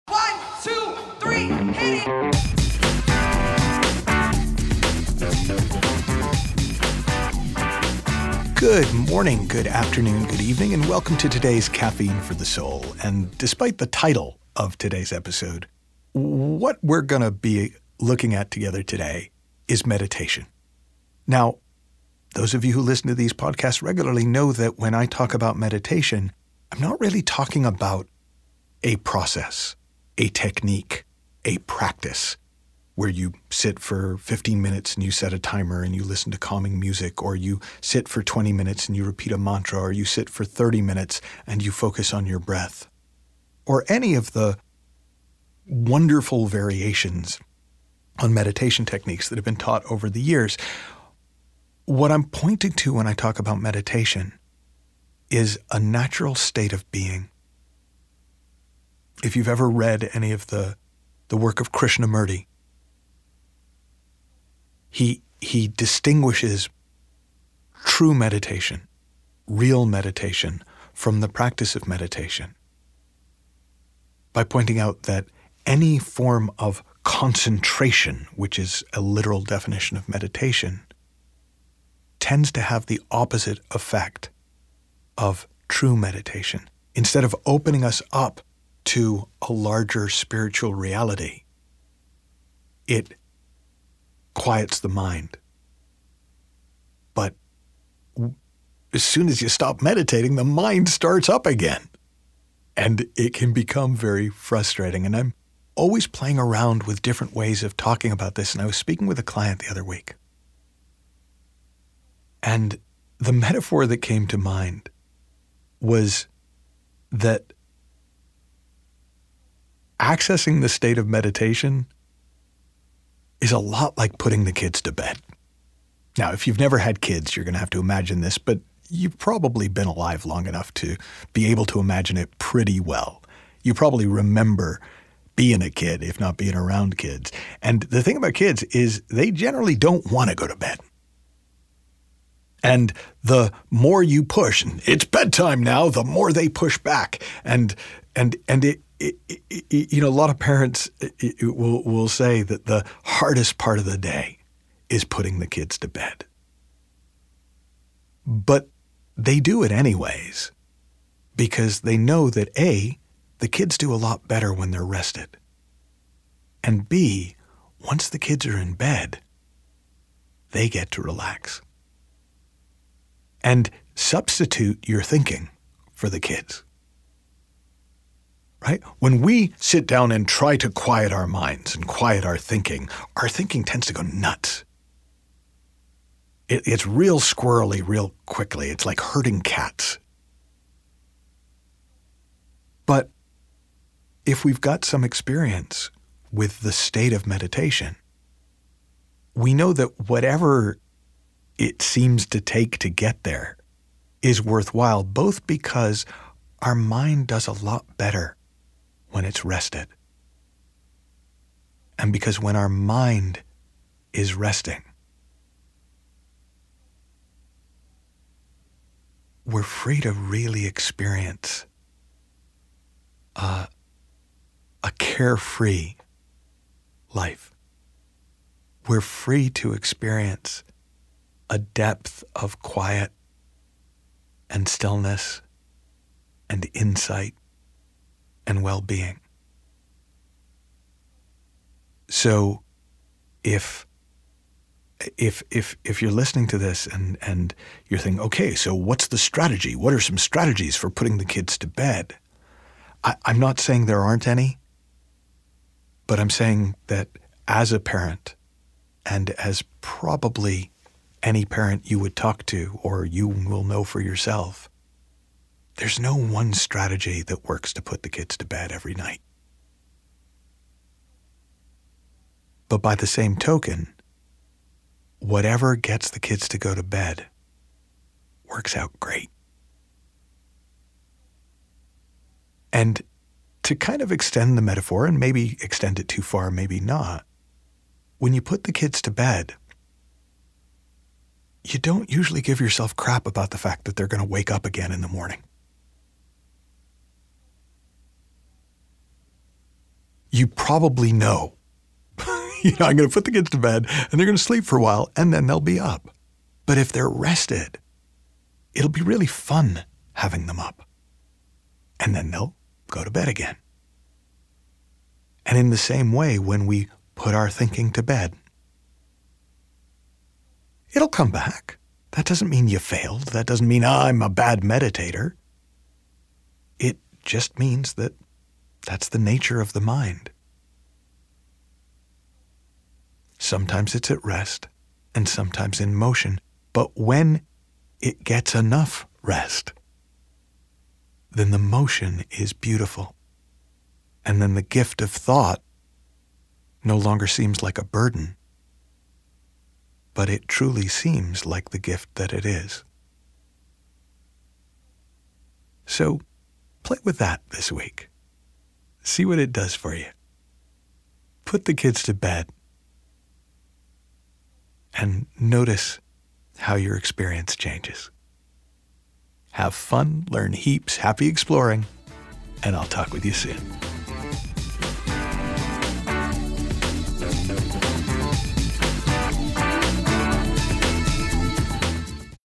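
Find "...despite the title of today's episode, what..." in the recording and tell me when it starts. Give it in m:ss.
0:13.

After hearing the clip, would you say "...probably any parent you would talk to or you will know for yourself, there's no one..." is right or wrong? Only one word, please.
right.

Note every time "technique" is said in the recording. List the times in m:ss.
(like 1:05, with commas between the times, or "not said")
0:30, 0:48.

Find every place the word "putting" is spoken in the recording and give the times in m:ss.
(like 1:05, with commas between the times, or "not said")
2:04, 2:35, 4:10.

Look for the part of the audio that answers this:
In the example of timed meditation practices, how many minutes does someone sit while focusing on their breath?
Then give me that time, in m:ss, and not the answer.
0:40.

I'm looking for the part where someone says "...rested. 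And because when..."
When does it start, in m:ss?
3:29.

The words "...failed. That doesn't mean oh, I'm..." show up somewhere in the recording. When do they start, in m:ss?
5:22.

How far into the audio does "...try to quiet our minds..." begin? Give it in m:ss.
3:00.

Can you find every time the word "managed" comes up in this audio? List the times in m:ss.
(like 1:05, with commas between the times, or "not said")
not said.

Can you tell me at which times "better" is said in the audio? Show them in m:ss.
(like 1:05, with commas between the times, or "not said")
2:44, 3:27.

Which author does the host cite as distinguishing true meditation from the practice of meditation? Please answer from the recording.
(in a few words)
Krishnamurti.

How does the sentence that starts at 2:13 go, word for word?
You probably remember being a kid, if not being around kids.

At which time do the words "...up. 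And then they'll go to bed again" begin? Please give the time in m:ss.
5:10.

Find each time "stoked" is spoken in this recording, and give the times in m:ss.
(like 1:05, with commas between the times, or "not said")
not said.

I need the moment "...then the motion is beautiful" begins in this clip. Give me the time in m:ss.
5:41.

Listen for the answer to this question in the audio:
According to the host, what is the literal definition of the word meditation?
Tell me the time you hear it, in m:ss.
1:17.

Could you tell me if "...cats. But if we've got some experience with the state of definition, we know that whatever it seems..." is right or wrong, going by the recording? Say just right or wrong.
wrong.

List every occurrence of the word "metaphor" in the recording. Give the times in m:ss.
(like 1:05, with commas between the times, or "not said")
1:53, 4:44.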